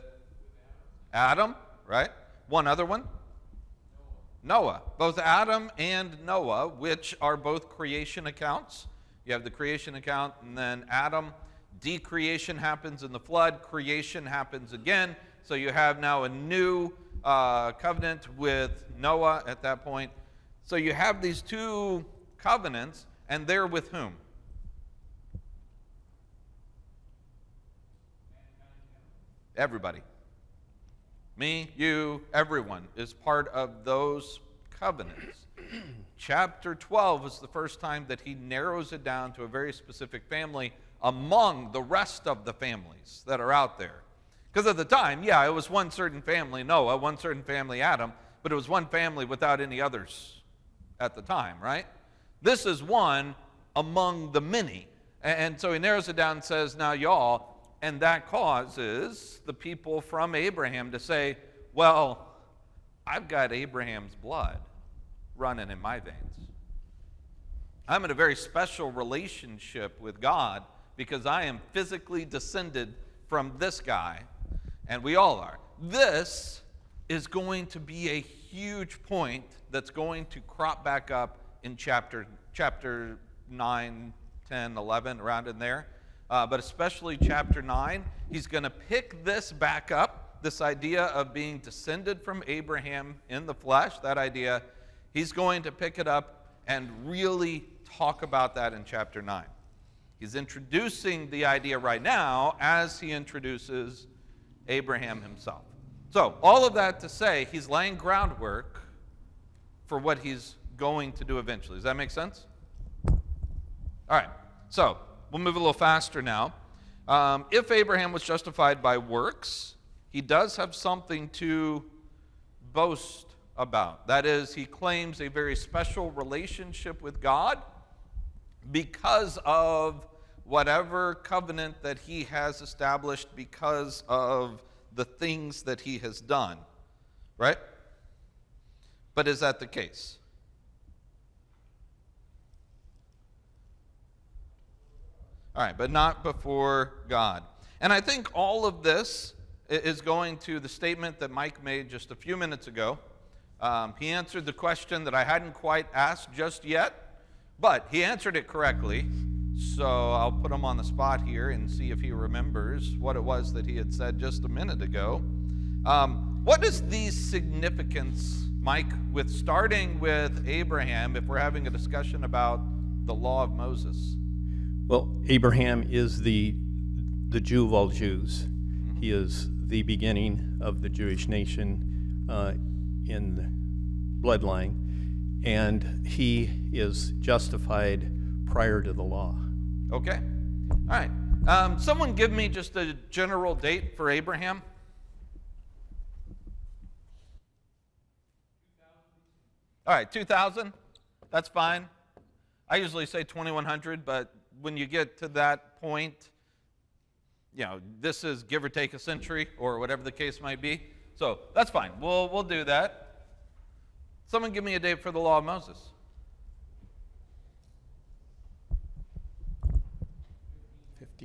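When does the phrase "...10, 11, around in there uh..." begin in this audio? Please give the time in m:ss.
1:24.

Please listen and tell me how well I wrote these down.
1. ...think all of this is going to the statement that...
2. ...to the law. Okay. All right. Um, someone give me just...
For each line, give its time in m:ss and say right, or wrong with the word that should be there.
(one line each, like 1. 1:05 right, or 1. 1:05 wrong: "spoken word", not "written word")
1. 2:27 right
2. 3:08 right.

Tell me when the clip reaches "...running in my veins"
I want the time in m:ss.
1:05.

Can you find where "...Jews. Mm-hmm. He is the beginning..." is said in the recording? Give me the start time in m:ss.
2:57.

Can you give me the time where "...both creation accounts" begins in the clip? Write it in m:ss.
0:07.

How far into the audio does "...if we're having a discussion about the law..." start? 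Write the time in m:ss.
2:51.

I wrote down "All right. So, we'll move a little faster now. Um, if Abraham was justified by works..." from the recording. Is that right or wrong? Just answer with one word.
right.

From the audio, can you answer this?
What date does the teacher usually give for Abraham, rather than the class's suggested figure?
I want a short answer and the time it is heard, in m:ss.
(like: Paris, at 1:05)
2100, at 3:23.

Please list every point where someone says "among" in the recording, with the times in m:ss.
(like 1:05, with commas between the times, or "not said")
0:41, 0:53.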